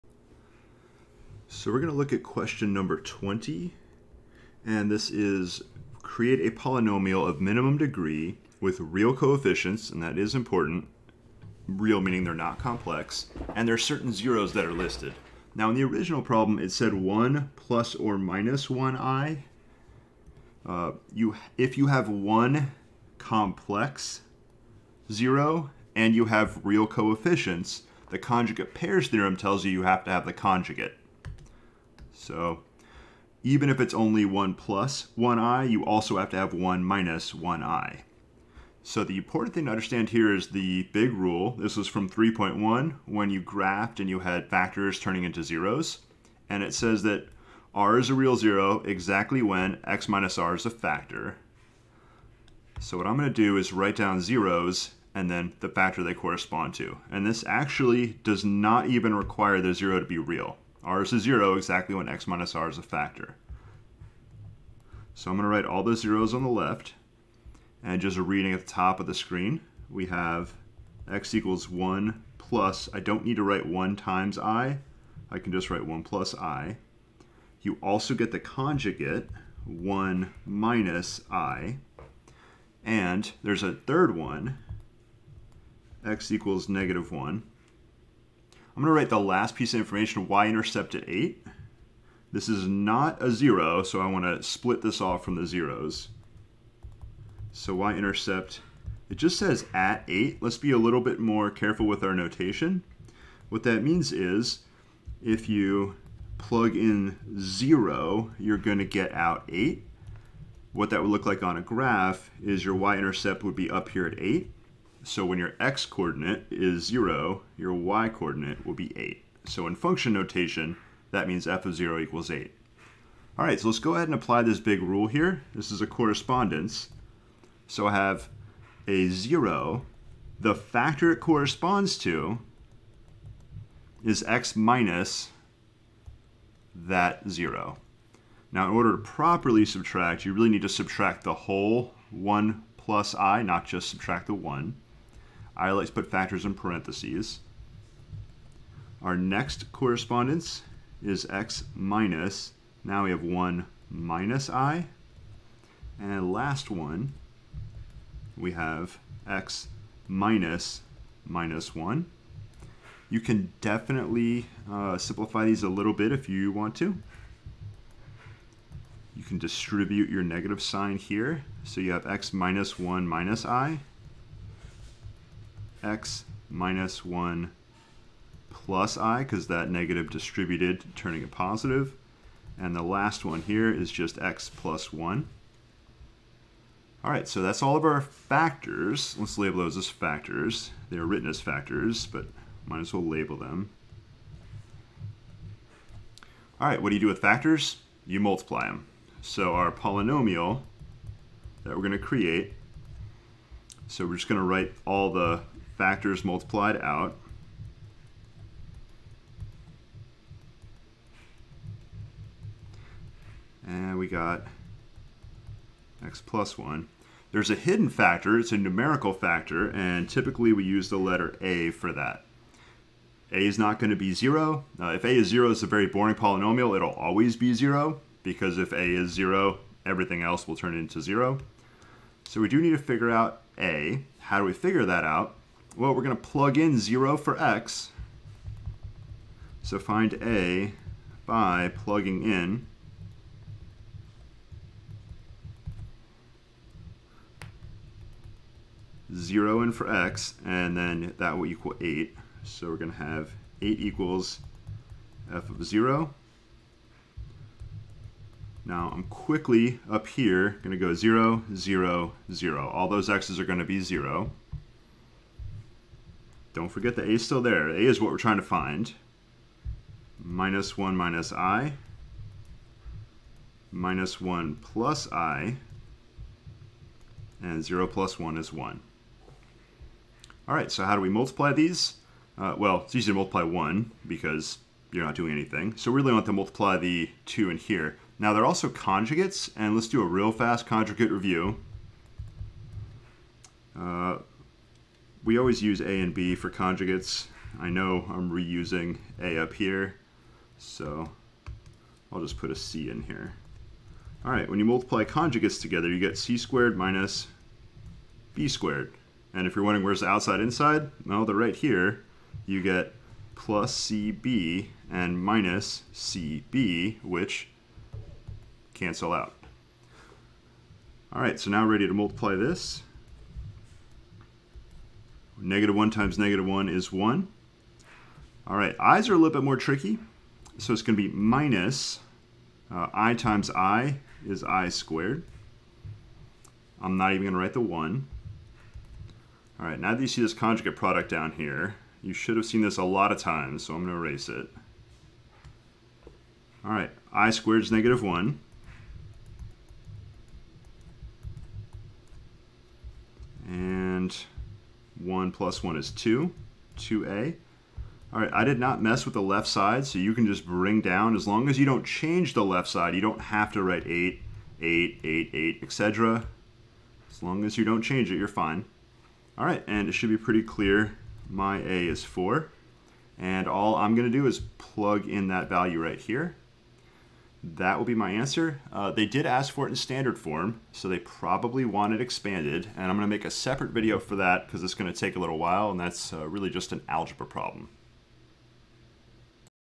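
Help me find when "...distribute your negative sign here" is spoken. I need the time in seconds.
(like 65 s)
169 s.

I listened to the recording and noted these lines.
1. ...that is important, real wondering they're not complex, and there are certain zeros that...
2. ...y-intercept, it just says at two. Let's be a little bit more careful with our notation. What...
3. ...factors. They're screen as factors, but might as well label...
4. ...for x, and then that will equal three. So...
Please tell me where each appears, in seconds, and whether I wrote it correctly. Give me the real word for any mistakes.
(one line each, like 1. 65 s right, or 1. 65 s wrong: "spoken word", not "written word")
1. 10 s wrong: "meaning", not "wondering"
2. 97 s wrong: "eight", not "two"
3. 189 s wrong: "written", not "screen"
4. 249 s wrong: "eight", not "three".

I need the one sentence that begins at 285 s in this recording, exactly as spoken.
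So we really want to multiply the 2 in here.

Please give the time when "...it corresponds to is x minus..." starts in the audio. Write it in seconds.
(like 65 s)
131 s.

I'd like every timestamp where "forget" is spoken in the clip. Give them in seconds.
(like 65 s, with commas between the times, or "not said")
266 s.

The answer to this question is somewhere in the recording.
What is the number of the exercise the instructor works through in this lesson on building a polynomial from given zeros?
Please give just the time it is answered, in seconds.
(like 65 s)
2 s.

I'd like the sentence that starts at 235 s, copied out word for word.
Well, we're going to plug in 0 for x.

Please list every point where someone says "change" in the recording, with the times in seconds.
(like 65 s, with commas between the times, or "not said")
361 s, 367 s.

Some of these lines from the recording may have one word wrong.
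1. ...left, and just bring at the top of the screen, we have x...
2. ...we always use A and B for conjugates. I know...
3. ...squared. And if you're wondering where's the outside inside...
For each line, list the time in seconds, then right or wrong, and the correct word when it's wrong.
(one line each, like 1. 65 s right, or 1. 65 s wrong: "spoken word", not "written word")
1. 66 s wrong: "reading", not "bring"
2. 295 s right
3. 308 s right.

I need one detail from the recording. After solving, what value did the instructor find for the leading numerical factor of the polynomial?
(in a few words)
4.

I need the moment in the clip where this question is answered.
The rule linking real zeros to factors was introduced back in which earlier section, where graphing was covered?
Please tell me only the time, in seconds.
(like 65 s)
42 s.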